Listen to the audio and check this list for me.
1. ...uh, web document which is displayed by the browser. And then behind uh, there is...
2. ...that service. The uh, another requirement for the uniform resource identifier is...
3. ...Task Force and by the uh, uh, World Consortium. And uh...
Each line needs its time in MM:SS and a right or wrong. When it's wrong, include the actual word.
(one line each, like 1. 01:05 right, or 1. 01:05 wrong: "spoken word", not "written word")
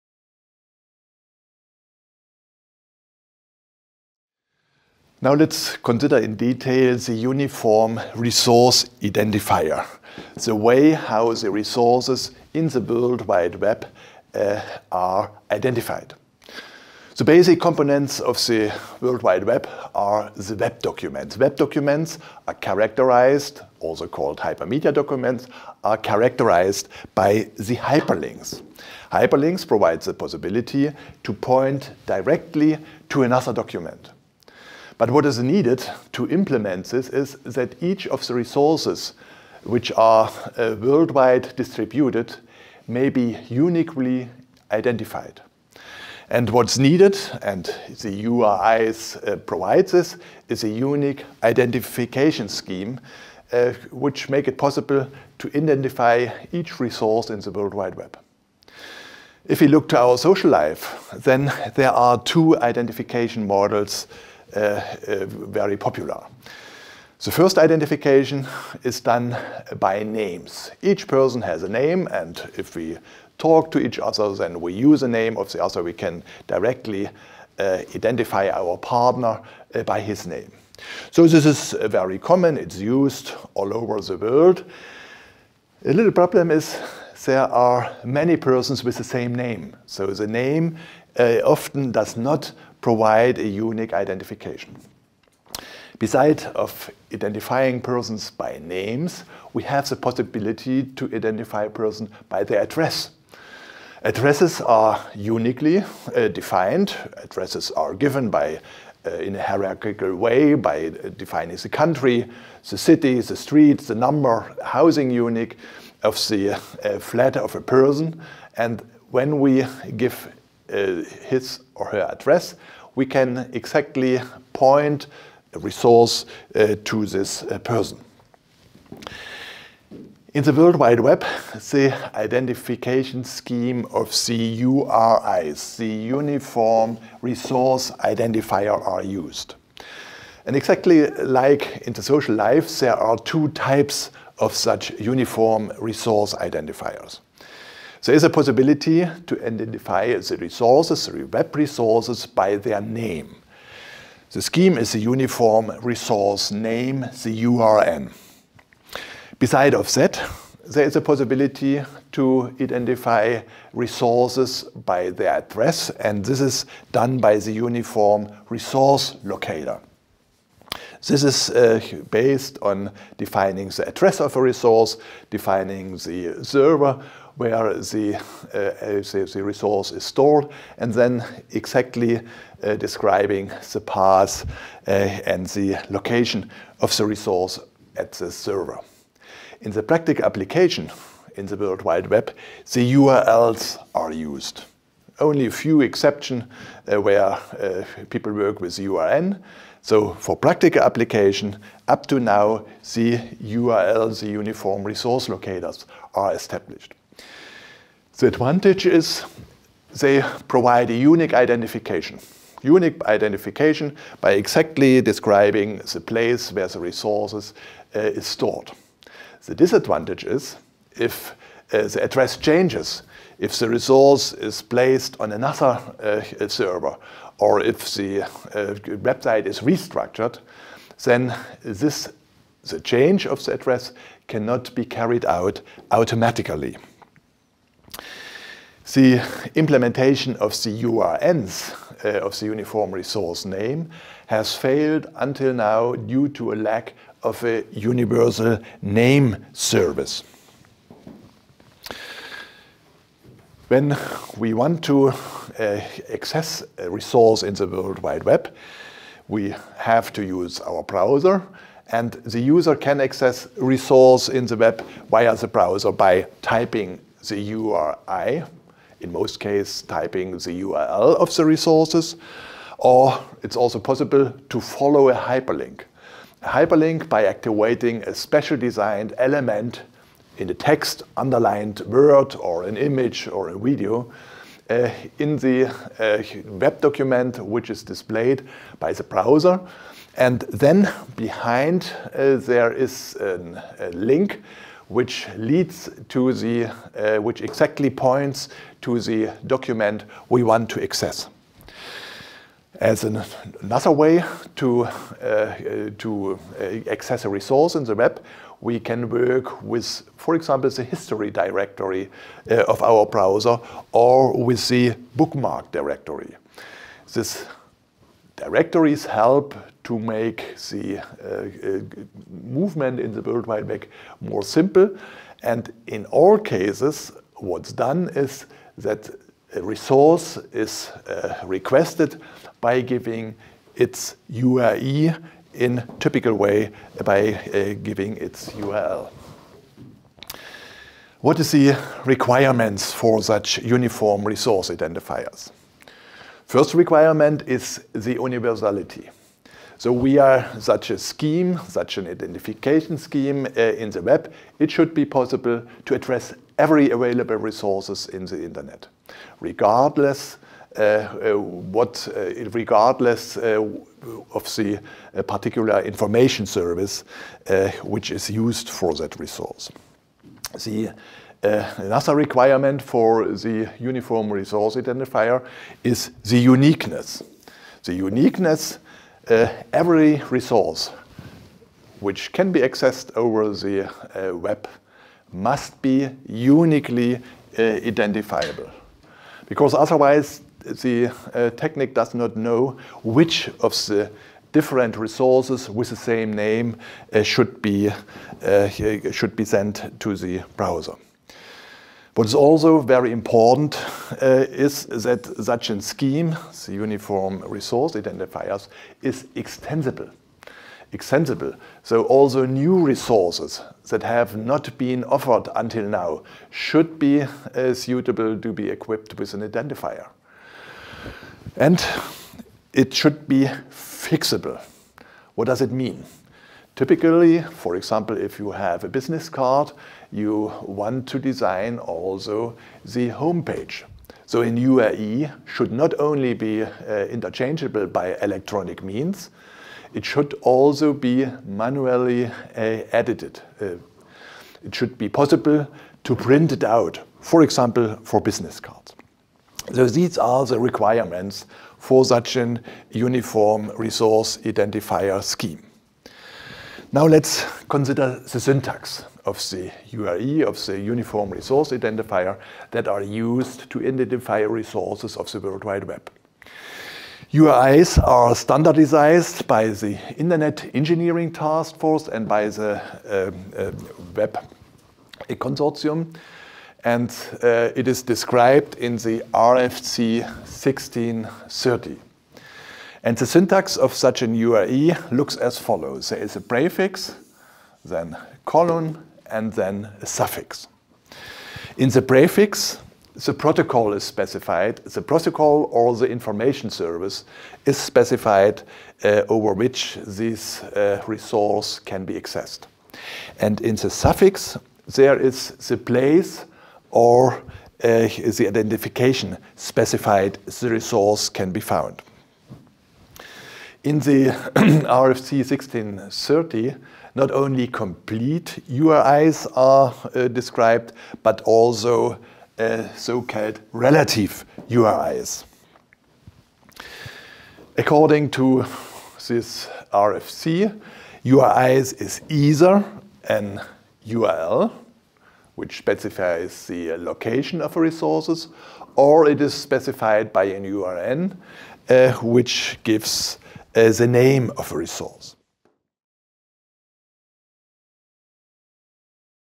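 1. 04:45 right
2. 06:08 wrong: "resource", not "service"
3. 07:51 wrong: "Web", not "World".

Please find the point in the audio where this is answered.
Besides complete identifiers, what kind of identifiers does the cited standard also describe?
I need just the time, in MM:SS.
08:43.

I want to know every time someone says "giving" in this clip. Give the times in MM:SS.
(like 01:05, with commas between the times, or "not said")
05:32, 05:37.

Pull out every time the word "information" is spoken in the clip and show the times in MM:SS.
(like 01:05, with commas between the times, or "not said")
06:05, 08:16.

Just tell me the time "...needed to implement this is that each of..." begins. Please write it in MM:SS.
00:35.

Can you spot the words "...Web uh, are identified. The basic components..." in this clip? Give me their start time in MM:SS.
00:13.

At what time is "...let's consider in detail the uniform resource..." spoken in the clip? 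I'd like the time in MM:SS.
00:05.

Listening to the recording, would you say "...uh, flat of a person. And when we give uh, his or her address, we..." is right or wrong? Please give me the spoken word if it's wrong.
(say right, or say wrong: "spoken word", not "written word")
right.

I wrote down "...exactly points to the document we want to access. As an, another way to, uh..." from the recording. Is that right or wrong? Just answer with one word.
right.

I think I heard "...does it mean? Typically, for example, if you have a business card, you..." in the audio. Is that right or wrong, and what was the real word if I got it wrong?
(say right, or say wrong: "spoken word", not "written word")
right.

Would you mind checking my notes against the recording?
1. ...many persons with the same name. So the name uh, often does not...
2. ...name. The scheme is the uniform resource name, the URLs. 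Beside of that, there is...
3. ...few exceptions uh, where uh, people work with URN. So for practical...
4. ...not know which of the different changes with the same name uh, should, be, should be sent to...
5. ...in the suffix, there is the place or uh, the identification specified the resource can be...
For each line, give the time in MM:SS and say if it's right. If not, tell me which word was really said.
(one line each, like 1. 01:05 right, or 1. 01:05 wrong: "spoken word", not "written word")
1. 01:28 right
2. 02:32 wrong: "URN", not "URLs"
3. 03:15 right
4. 06:32 wrong: "resources", not "changes"
5. 08:23 right.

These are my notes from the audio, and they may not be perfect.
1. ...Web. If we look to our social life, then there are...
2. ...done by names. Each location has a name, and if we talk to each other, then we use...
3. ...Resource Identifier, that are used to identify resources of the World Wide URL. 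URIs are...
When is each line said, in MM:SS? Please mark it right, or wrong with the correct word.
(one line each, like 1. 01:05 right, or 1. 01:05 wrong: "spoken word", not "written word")
1. 00:57 right
2. 01:08 wrong: "person", not "location"
3. 07:41 wrong: "Web", not "URL".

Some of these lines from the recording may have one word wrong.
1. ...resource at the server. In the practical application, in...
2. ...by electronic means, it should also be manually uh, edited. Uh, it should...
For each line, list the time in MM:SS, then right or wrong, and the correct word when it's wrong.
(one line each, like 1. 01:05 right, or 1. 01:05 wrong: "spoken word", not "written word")
1. 03:07 right
2. 07:17 right.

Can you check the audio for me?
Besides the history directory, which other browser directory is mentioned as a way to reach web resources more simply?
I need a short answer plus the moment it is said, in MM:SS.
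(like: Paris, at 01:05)
Bookmark directory, at 05:15.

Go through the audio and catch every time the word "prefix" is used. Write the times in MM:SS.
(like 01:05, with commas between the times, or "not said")
08:06, 08:12.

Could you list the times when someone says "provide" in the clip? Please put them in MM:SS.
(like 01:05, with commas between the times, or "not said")
00:29, 00:49, 01:32, 03:30.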